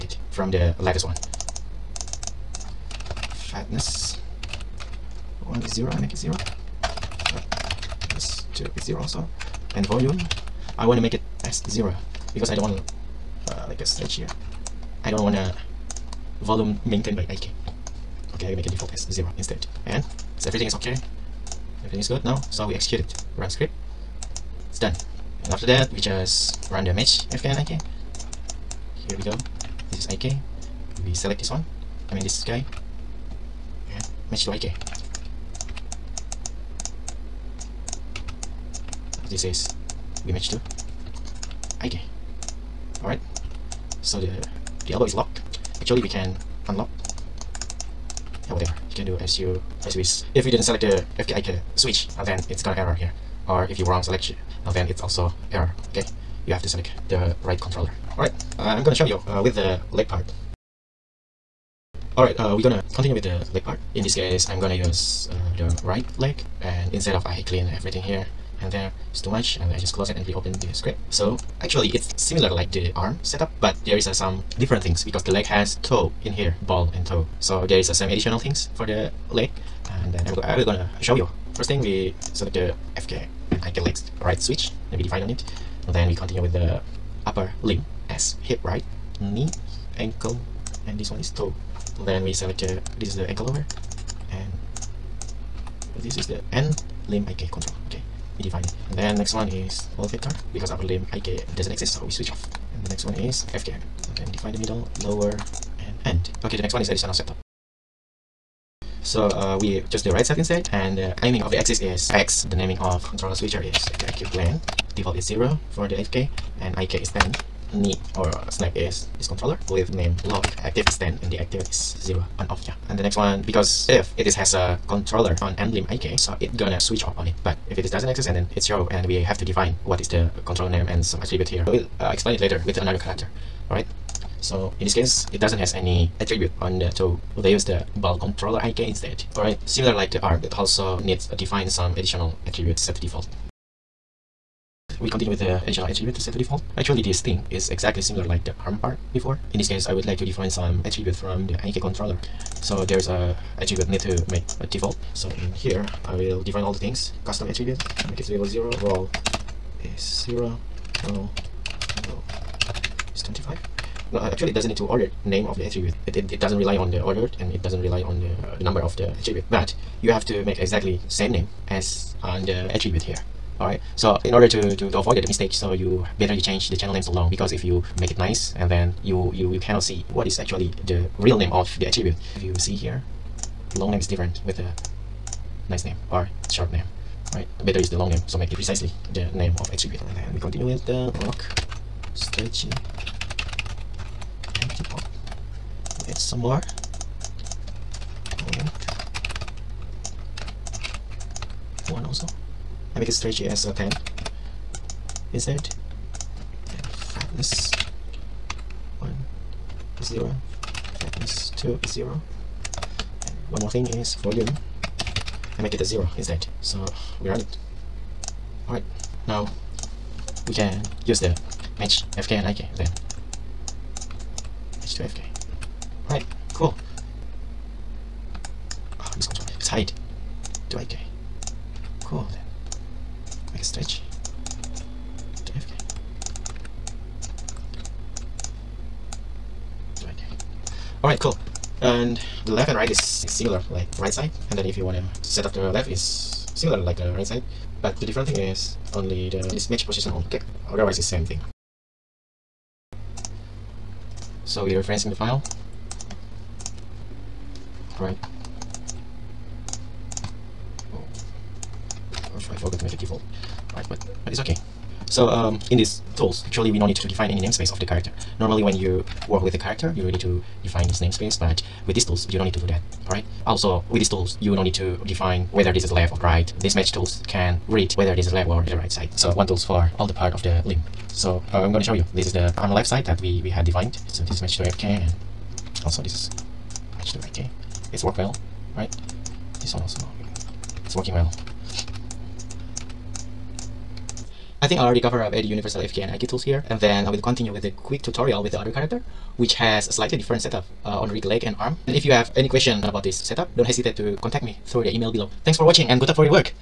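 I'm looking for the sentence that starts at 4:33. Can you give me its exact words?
Also, with these tools, you don't need to define whether this is left or right.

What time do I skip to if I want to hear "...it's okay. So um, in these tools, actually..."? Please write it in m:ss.
4:24.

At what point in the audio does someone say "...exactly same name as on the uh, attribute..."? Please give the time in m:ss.
2:50.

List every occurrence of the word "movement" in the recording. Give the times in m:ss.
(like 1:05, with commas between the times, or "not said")
not said.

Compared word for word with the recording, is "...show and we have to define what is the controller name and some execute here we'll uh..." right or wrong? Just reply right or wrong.
wrong.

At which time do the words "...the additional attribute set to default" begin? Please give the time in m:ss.
2:25.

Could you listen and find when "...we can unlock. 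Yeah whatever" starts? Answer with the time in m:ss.
0:46.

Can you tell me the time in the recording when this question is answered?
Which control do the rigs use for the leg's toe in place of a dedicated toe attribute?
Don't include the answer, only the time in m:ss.
2:17.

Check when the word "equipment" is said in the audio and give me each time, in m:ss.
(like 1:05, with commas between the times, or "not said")
not said.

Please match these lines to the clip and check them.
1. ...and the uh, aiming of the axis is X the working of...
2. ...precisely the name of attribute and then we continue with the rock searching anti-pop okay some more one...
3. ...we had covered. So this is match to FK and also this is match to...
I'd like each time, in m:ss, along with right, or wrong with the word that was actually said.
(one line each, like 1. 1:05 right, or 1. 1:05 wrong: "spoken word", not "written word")
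1. 1:50 wrong: "naming", not "working"
2. 3:08 right
3. 4:43 wrong: "defined", not "covered".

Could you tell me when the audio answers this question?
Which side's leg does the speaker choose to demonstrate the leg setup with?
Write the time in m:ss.
1:05.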